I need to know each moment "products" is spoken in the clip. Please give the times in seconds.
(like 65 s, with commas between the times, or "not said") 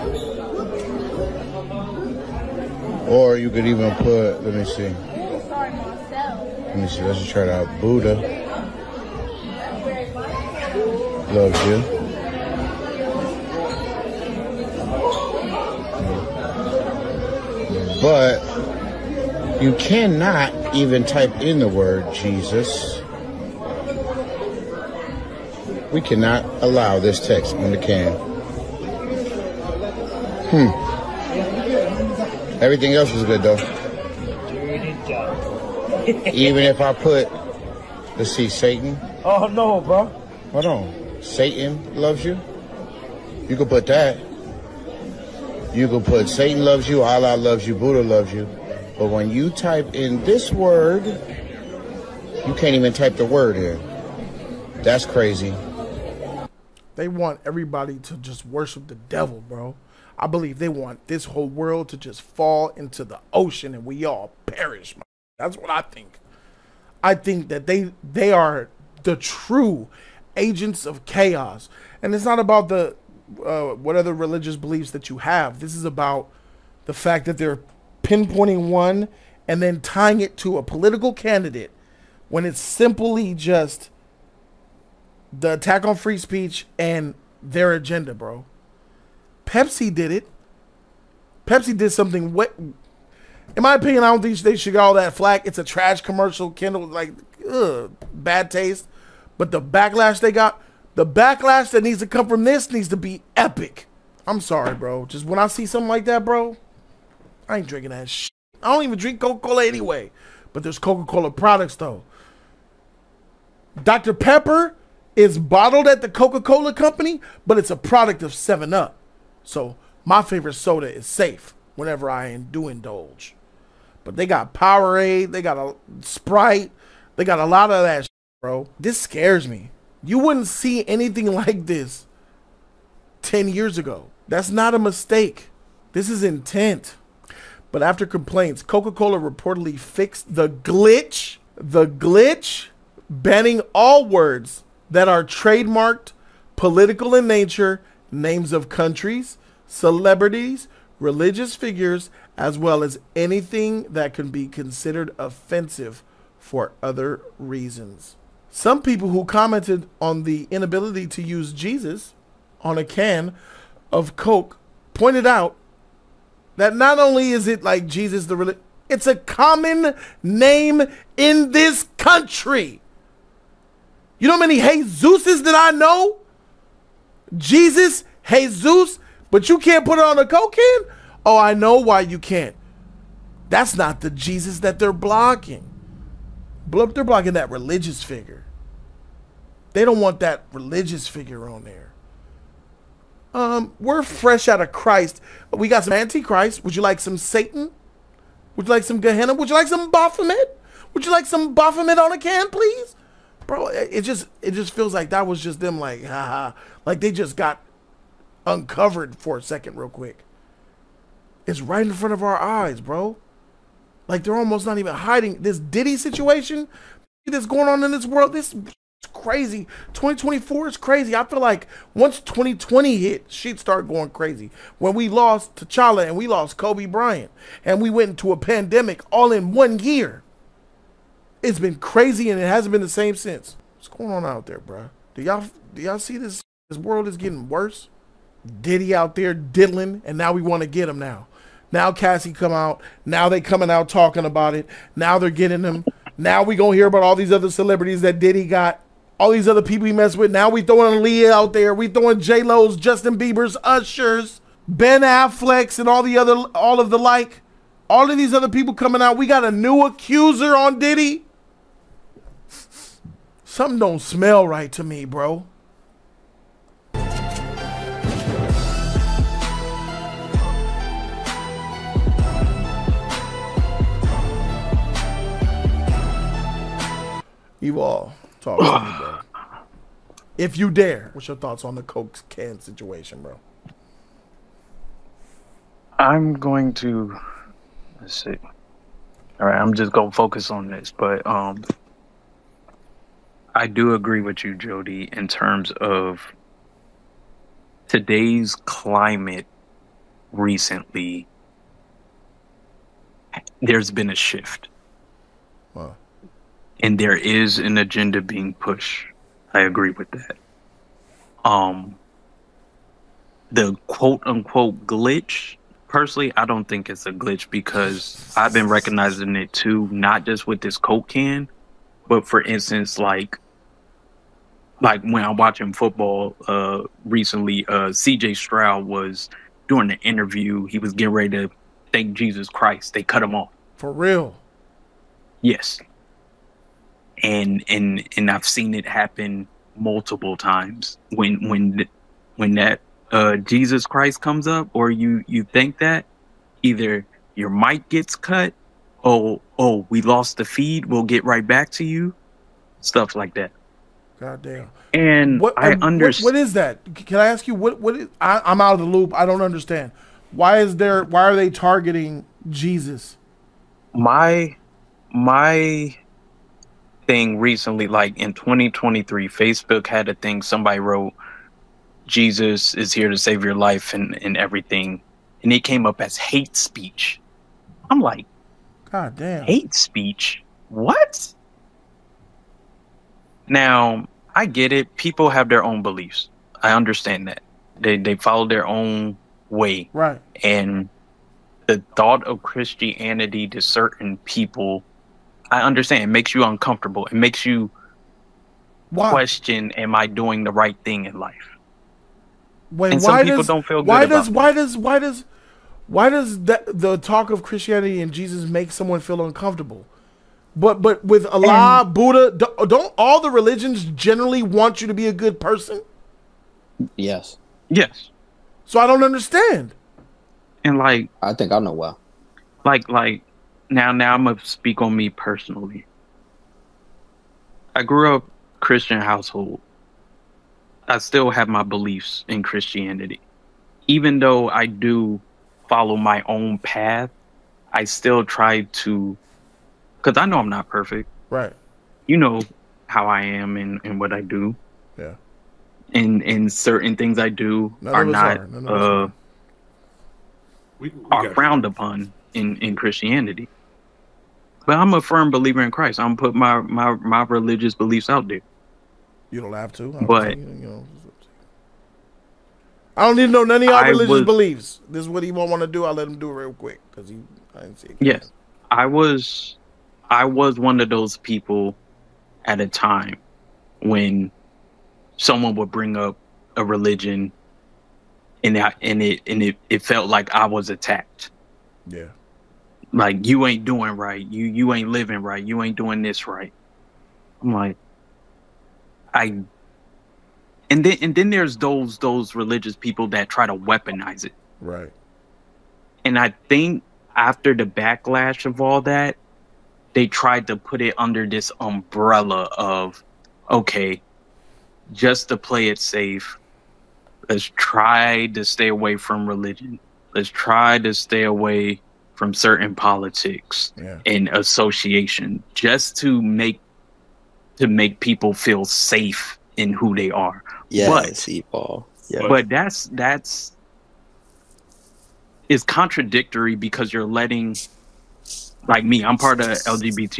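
111 s, 117 s.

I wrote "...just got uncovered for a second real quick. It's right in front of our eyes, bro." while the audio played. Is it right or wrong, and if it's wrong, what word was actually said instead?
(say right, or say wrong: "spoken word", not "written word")
right.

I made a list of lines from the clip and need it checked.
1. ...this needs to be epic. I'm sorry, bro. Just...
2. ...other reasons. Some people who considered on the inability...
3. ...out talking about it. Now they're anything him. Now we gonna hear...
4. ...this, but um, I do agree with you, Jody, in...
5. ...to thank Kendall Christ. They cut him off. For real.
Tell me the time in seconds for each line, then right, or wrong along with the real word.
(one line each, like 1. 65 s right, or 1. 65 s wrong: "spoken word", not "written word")
1. 102 s right
2. 156 s wrong: "commented", not "considered"
3. 243 s wrong: "getting", not "anything"
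4. 290 s right
5. 331 s wrong: "Jesus", not "Kendall".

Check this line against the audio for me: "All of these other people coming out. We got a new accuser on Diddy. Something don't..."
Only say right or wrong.
right.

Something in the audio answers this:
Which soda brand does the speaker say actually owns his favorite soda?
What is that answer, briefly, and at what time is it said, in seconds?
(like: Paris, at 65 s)
7 Up, at 118 s.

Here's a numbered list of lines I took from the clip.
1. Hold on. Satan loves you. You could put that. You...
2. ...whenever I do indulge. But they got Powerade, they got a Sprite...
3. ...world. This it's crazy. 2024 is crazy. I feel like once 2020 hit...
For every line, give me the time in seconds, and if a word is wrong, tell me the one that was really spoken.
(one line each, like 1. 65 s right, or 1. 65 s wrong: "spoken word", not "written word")
1. 40 s right
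2. 121 s right
3. 218 s right.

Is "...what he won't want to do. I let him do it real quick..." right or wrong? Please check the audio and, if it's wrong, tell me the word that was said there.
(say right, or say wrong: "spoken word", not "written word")
right.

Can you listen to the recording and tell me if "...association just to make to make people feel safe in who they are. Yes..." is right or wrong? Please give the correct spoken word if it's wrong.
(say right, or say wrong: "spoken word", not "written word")
right.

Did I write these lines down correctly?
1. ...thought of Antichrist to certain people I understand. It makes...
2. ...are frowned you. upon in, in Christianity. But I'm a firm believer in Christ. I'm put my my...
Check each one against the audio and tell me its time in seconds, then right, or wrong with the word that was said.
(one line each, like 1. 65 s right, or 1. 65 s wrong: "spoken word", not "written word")
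1. 391 s wrong: "Christianity", not "Antichrist"
2. 451 s right.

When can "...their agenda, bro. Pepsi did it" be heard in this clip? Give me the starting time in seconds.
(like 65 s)
87 s.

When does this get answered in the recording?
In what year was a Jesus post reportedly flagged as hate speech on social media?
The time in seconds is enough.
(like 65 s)
368 s.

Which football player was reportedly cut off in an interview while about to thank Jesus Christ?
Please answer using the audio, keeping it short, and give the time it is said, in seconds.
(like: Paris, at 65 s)
CJ Stroud, at 327 s.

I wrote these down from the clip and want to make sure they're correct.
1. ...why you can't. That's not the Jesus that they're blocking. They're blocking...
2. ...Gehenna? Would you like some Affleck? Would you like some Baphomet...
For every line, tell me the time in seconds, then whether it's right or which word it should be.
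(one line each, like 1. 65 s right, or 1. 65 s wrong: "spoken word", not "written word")
1. 181 s right
2. 198 s wrong: "Baphomet", not "Affleck".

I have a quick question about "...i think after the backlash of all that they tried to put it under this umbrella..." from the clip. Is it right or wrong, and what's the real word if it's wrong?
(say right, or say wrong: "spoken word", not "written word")
right.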